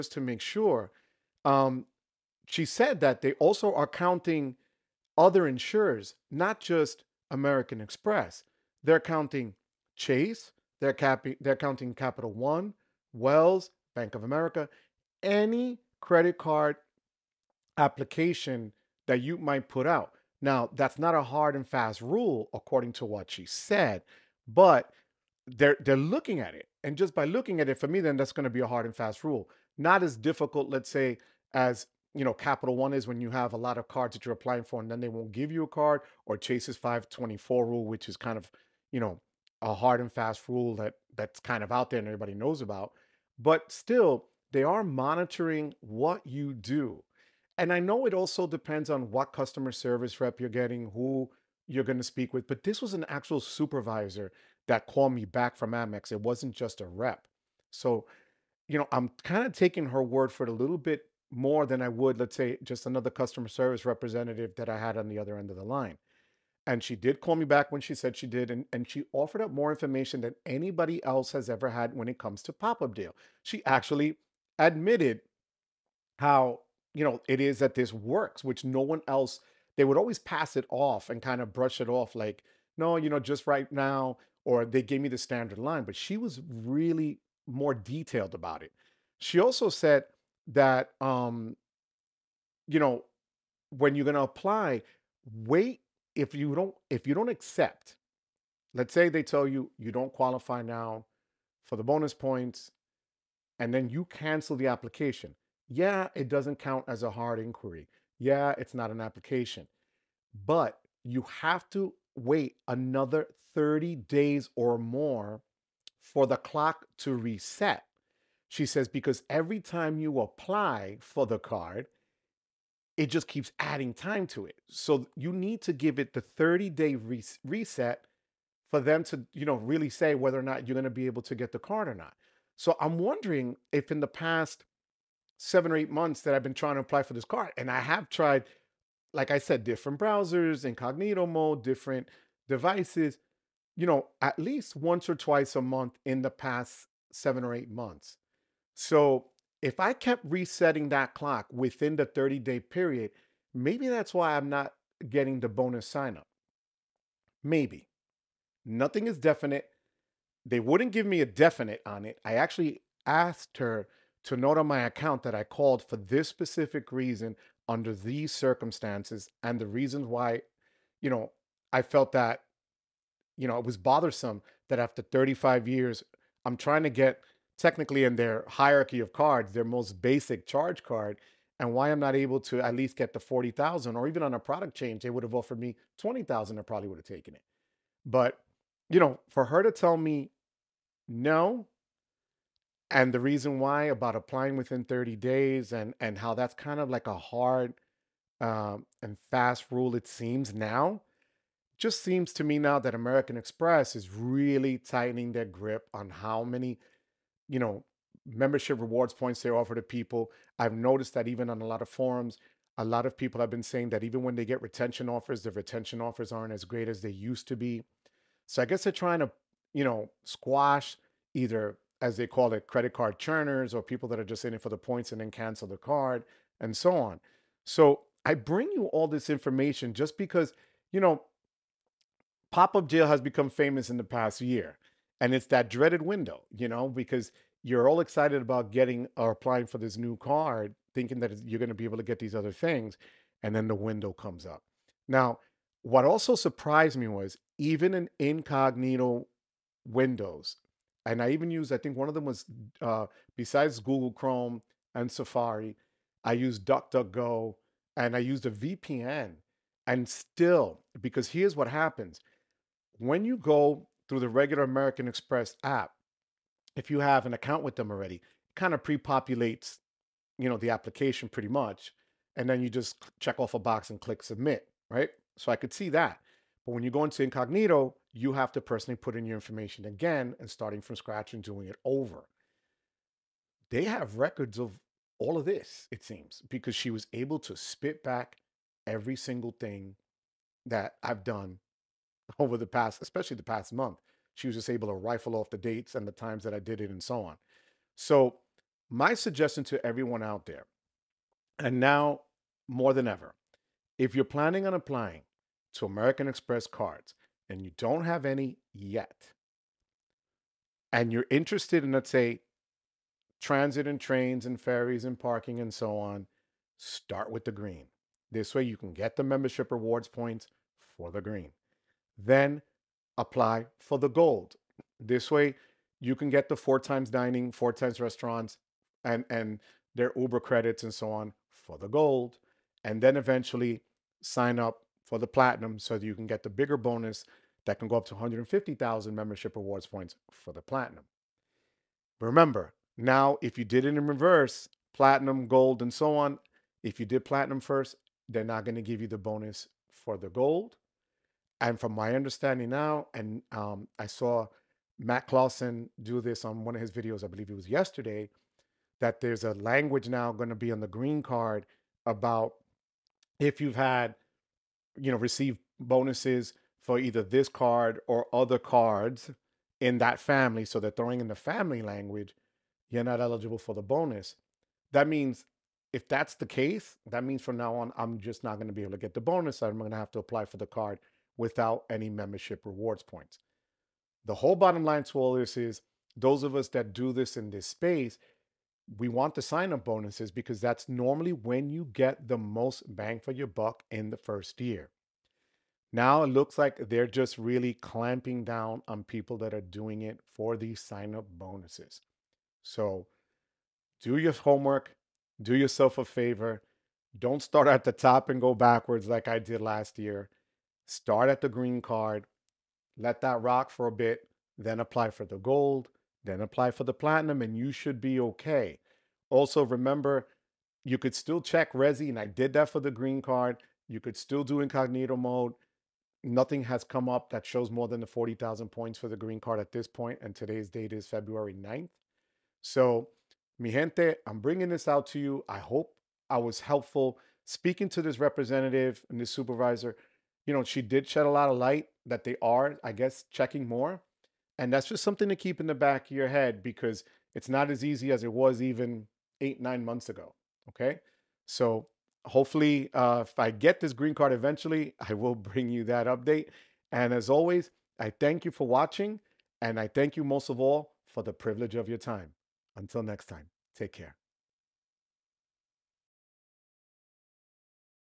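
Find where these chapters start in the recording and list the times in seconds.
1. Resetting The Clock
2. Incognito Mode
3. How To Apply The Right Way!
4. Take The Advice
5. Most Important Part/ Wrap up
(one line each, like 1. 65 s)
1. 104 s
2. 248 s
3. 308 s
4. 49 s
5. 434 s.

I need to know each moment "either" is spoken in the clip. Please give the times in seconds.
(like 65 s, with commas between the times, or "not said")
221 s, 366 s.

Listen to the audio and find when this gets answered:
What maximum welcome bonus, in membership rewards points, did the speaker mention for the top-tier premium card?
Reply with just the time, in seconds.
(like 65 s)
338 s.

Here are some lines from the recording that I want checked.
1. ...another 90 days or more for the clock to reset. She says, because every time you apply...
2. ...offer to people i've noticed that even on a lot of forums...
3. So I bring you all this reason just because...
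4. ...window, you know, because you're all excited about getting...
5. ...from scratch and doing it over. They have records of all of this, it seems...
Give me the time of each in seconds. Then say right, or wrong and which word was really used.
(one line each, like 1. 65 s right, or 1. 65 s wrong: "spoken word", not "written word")
1. 112 s wrong: "30", not "90"
2. 209 s right
3. 227 s wrong: "information", not "reason"
4. 236 s right
5. 280 s right.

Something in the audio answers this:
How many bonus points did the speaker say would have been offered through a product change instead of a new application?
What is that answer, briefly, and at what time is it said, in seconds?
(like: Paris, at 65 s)
20,000, at 185 s.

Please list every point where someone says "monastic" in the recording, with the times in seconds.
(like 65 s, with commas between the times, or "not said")
not said.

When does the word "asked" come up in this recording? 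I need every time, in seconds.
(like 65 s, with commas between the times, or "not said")
163 s.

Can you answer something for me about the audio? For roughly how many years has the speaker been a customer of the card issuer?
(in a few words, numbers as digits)
35.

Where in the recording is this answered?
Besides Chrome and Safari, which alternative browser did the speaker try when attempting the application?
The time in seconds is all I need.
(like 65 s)
256 s.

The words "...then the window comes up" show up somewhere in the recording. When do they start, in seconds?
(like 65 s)
243 s.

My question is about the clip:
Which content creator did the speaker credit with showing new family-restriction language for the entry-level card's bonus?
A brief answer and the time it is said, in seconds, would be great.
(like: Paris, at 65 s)
Matt Clausen, at 354 s.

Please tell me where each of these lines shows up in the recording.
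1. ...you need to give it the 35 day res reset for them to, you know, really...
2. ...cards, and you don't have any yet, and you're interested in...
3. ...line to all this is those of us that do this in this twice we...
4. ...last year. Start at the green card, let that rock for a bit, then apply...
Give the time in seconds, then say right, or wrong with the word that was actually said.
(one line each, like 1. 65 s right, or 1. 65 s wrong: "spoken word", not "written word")
1. 125 s wrong: "30", not "35"
2. 306 s right
3. 384 s wrong: "space", not "twice"
4. 409 s right.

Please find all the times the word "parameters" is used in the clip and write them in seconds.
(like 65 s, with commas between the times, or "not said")
not said.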